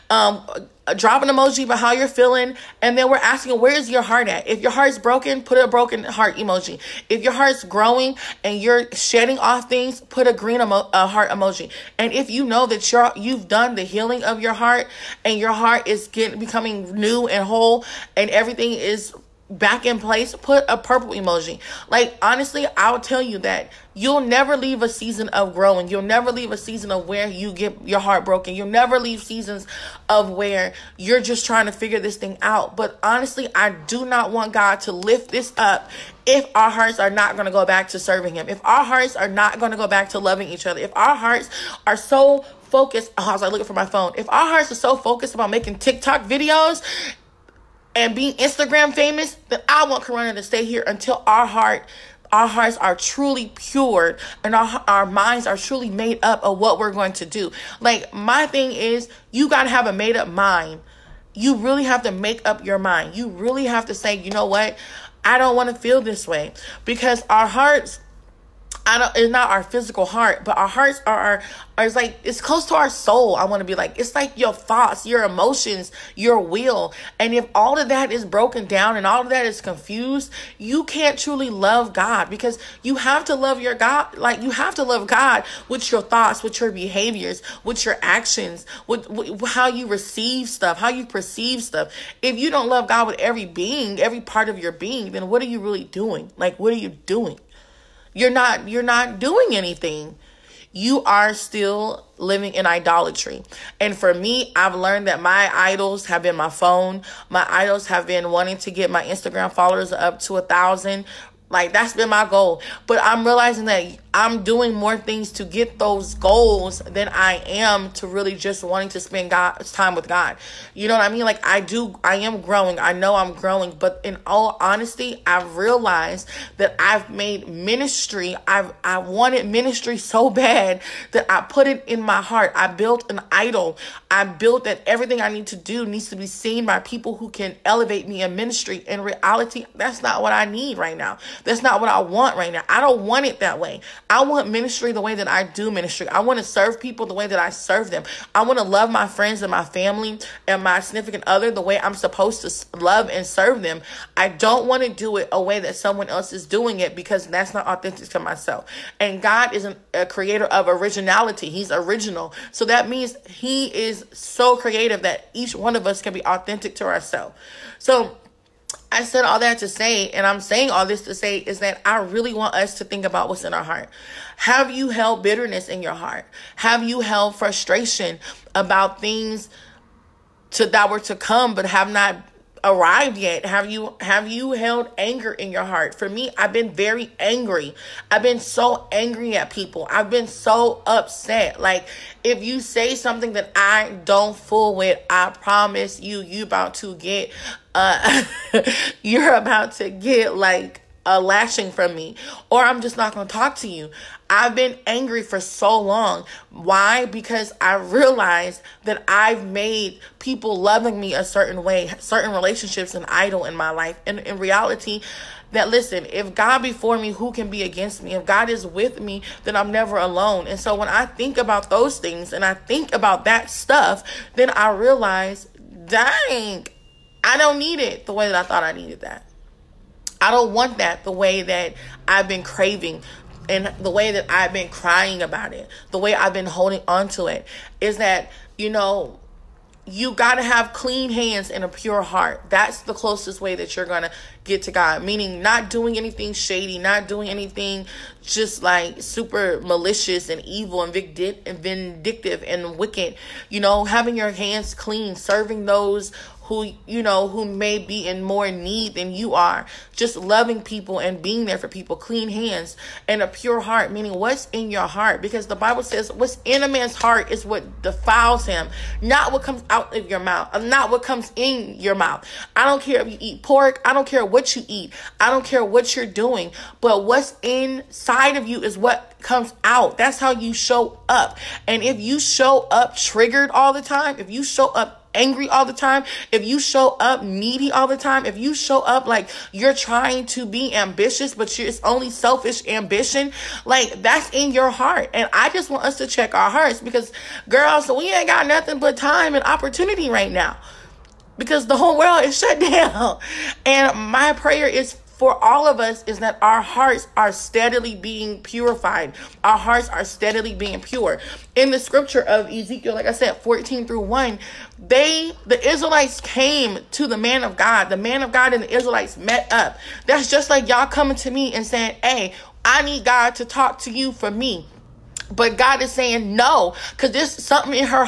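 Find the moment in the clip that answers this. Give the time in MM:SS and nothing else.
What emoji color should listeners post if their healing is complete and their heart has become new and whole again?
00:20.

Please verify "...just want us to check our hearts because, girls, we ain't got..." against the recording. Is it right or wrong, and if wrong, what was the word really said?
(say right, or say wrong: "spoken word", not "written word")
right.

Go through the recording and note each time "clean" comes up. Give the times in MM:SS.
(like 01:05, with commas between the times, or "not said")
04:00, 04:14, 04:21.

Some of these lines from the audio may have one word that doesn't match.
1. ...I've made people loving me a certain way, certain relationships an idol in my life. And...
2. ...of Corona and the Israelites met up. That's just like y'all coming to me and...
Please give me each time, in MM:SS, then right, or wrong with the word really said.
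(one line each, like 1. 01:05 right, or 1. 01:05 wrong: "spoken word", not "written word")
1. 03:29 right
2. 05:18 wrong: "God", not "Corona".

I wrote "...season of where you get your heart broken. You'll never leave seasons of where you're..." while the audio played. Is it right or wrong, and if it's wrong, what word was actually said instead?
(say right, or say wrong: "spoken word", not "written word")
right.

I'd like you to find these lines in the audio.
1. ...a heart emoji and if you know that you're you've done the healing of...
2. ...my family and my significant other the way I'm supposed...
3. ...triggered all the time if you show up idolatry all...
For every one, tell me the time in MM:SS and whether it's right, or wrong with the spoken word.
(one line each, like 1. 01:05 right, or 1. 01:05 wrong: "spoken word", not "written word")
1. 00:10 right
2. 02:29 right
3. 04:42 wrong: "angry", not "idolatry".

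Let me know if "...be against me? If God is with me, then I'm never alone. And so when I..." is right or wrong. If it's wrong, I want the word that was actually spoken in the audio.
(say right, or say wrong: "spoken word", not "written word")
right.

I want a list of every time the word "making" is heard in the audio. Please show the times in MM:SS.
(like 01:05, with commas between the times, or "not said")
00:45.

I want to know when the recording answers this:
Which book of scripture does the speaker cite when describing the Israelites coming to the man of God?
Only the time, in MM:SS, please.
05:12.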